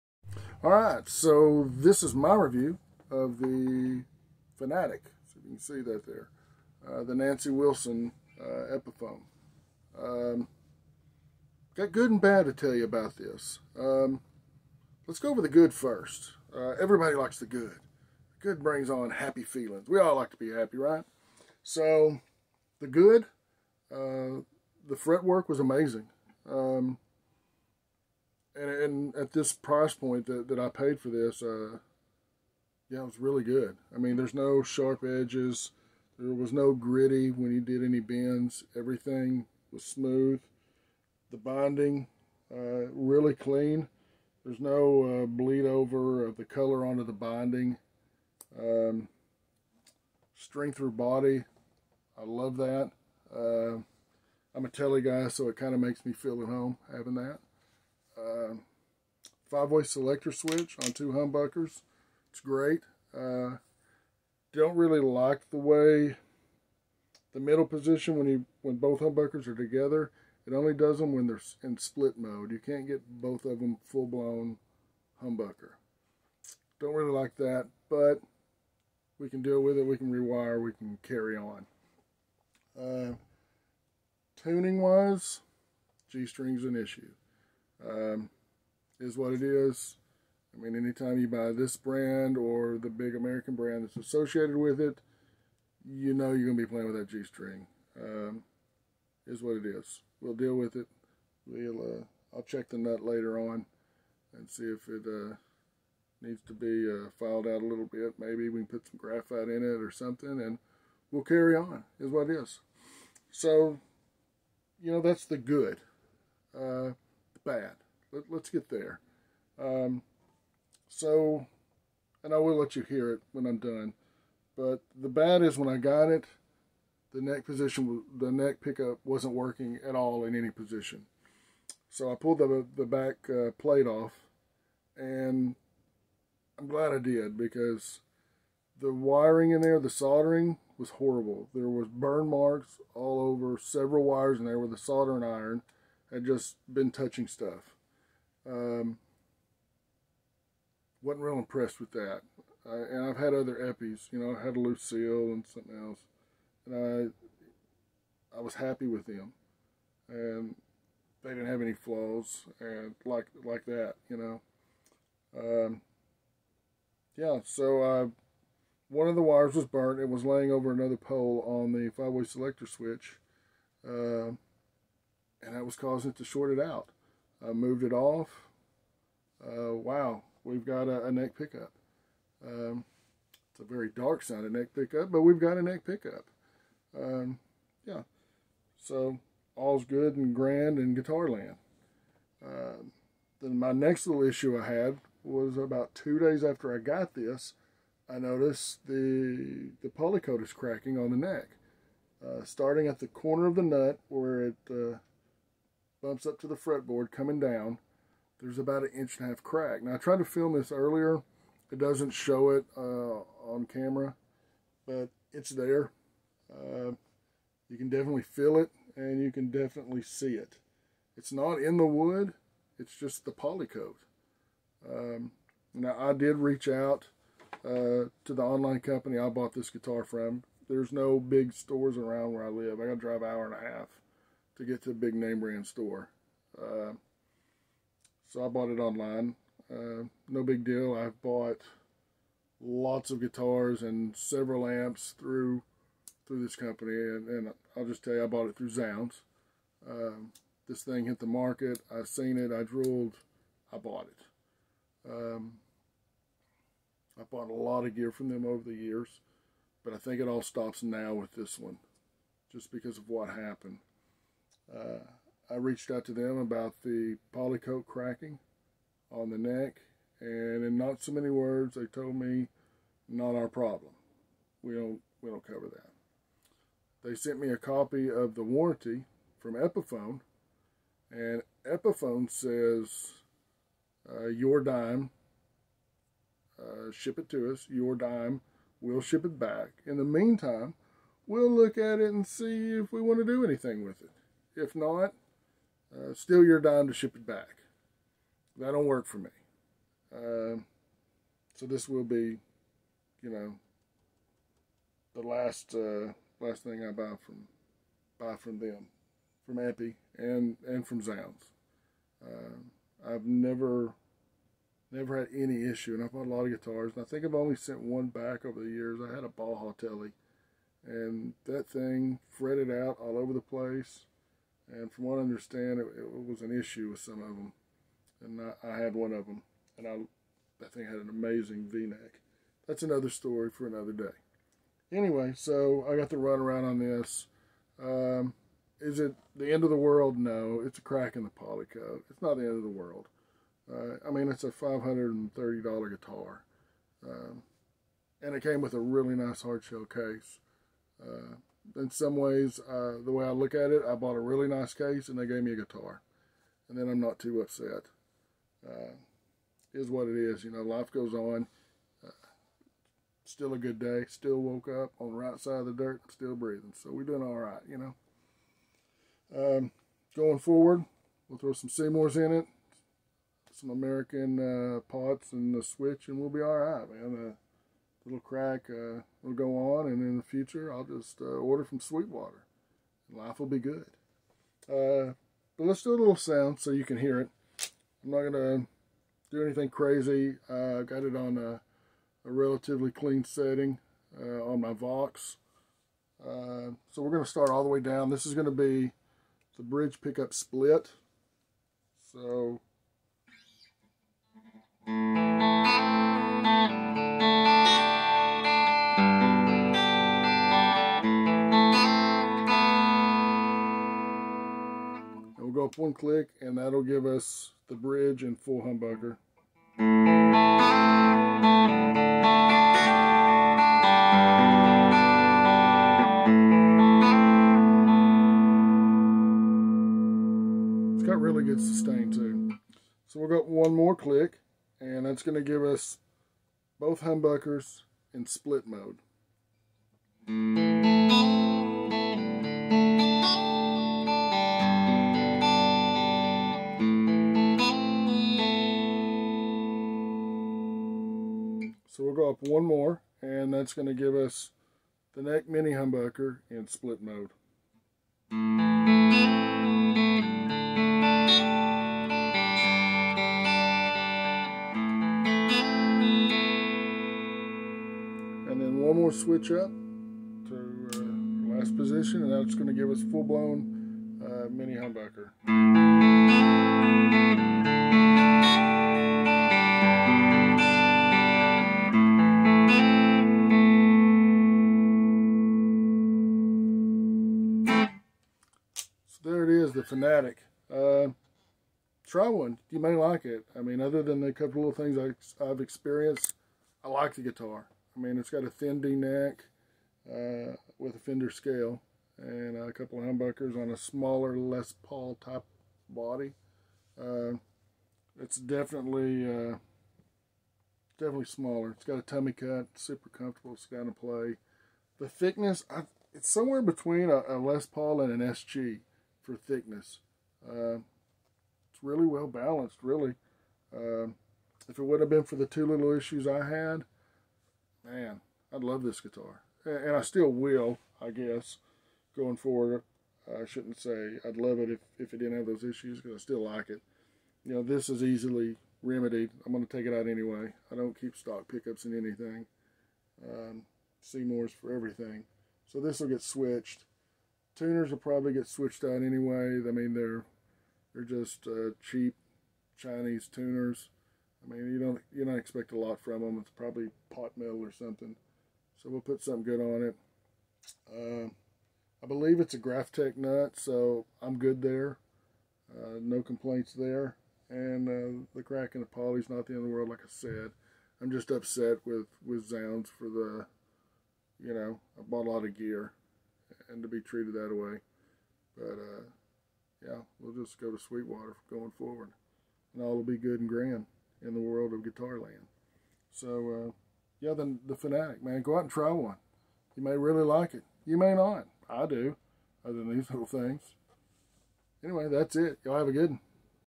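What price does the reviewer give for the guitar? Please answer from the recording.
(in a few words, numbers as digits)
$530.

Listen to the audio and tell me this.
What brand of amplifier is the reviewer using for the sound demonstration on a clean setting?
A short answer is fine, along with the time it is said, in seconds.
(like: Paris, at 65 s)
Vox, at 394 s.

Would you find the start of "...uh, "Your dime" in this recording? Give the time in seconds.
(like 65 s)
284 s.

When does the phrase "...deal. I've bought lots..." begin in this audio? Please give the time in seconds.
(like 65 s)
240 s.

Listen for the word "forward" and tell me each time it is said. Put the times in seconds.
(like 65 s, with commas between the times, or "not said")
370 s, 532 s, 581 s.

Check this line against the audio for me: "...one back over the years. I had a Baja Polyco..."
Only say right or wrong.
wrong.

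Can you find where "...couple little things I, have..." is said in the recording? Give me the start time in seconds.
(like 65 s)
494 s.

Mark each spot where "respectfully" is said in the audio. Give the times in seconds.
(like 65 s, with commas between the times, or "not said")
not said.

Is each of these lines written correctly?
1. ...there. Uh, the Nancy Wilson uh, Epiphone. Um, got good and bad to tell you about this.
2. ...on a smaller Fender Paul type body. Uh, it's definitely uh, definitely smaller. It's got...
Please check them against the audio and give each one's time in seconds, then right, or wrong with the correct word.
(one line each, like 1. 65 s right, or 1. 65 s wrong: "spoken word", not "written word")
1. 6 s right
2. 503 s wrong: "Les", not "Fender".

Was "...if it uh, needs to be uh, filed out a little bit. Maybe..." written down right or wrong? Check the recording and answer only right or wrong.
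right.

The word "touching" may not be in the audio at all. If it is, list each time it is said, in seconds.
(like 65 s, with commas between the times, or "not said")
146 s.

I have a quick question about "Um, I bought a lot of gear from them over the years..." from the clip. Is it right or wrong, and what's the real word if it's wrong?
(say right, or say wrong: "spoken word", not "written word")
right.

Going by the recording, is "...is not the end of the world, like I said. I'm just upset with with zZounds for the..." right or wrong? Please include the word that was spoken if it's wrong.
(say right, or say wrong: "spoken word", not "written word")
right.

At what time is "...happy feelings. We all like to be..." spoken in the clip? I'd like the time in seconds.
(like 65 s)
19 s.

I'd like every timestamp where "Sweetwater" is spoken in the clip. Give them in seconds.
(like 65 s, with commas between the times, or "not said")
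381 s, 580 s.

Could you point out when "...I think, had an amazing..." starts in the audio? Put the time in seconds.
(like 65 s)
330 s.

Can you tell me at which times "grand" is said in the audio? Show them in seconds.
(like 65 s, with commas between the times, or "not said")
190 s, 583 s.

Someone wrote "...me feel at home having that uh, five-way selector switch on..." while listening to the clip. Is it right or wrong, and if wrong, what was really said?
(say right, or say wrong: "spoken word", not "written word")
right.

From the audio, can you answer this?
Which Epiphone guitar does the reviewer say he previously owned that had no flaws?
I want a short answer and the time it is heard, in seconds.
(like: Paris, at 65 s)
Lucille, at 154 s.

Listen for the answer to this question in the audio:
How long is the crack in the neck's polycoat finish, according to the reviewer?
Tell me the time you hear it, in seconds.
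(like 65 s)
208 s.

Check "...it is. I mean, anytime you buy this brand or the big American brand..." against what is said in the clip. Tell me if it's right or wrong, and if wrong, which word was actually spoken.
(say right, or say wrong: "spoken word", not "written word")
right.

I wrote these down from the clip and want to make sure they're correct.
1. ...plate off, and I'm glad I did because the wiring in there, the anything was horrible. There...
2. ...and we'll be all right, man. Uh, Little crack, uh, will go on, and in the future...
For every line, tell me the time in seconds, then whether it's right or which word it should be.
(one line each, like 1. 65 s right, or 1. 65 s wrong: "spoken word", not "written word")
1. 133 s wrong: "soldering", not "anything"
2. 376 s right.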